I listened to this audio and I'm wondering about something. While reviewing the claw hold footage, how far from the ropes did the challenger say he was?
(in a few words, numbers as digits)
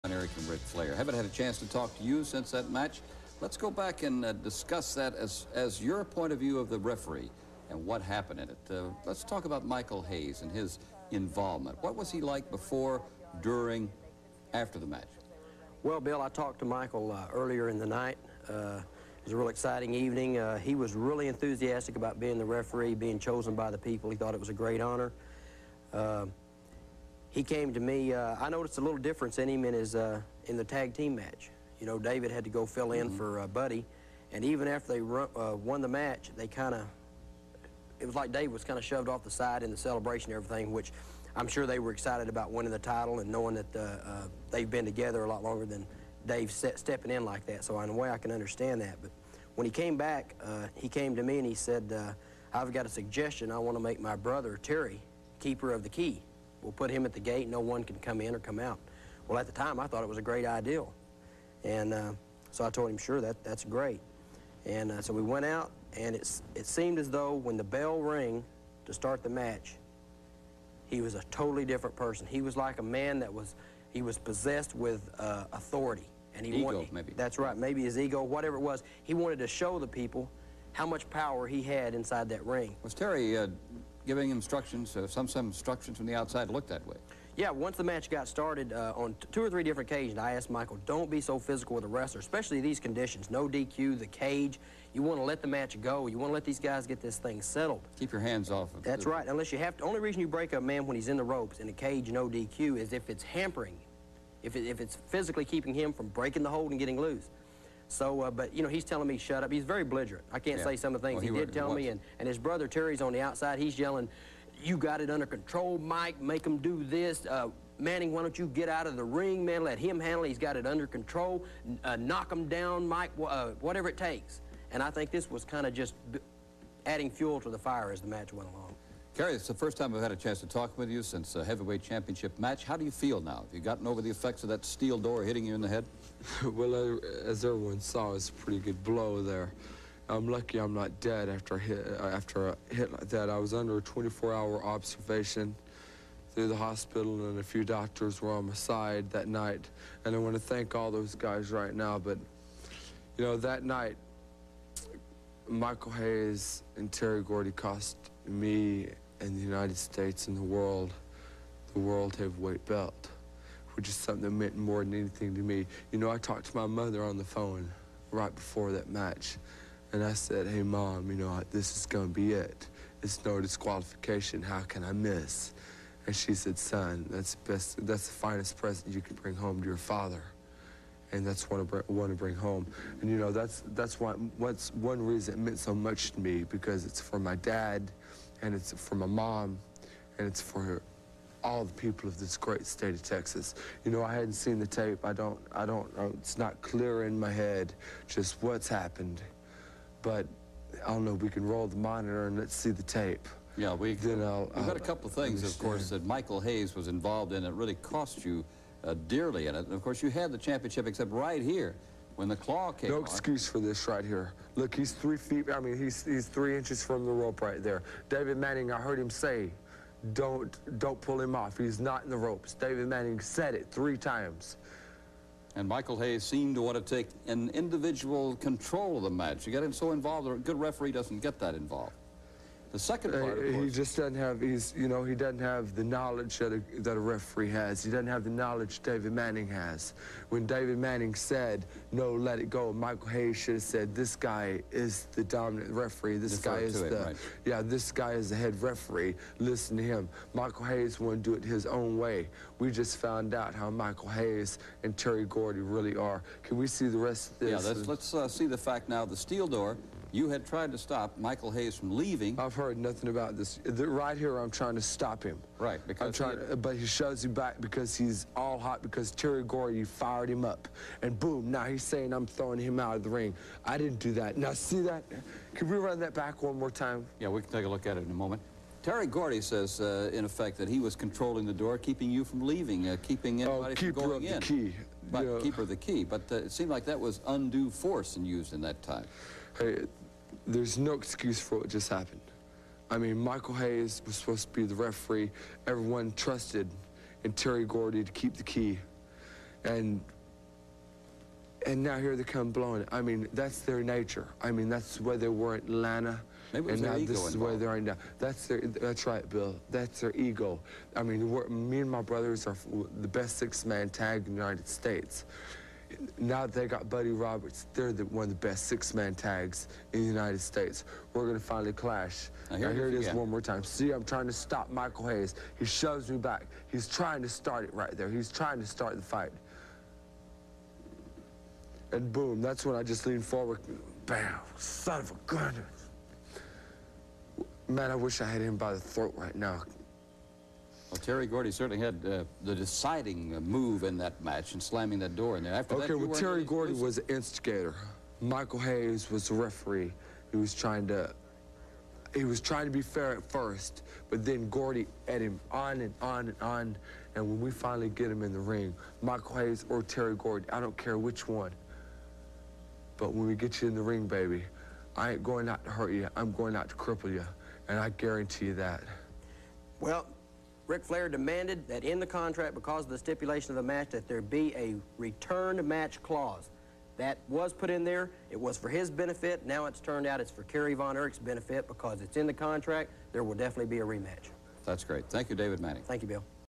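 Three inches.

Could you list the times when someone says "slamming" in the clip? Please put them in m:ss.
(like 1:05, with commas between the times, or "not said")
5:44.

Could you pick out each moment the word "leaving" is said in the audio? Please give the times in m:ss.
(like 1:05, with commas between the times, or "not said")
4:21, 4:42.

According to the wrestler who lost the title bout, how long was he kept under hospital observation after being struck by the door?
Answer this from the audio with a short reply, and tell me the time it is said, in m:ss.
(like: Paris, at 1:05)
24 hours, at 2:23.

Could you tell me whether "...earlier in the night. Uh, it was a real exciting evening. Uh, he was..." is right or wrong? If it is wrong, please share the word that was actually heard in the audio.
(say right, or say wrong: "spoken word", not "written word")
right.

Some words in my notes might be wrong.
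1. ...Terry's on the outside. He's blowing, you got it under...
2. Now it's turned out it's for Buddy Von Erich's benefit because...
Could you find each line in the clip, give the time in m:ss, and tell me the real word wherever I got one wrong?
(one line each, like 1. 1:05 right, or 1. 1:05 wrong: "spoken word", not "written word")
1. 1:52 wrong: "yelling", not "blowing"
2. 6:19 wrong: "Kerry", not "Buddy".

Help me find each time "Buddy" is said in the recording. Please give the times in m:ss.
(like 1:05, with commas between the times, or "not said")
0:33, 5:16.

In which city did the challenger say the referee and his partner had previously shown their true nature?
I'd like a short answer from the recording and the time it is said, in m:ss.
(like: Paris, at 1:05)
Atlanta, at 5:05.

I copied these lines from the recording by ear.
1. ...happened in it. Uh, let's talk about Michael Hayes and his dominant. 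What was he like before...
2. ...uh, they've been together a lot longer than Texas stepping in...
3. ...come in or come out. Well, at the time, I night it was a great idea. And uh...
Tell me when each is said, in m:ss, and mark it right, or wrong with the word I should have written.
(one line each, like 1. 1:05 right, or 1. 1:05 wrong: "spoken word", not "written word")
1. 0:08 wrong: "involvement", not "dominant"
2. 0:43 wrong: "Dave", not "Texas"
3. 0:57 wrong: "thought", not "night".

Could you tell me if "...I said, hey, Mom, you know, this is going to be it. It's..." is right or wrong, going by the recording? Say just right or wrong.
right.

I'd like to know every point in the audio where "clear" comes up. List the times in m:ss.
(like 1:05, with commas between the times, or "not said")
3:16.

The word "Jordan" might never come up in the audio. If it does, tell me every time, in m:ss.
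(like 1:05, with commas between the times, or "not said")
not said.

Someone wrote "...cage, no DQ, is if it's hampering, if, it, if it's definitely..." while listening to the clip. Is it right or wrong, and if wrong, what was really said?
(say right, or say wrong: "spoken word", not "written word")
wrong: "physically", not "definitely".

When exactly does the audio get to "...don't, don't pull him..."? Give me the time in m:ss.
3:40.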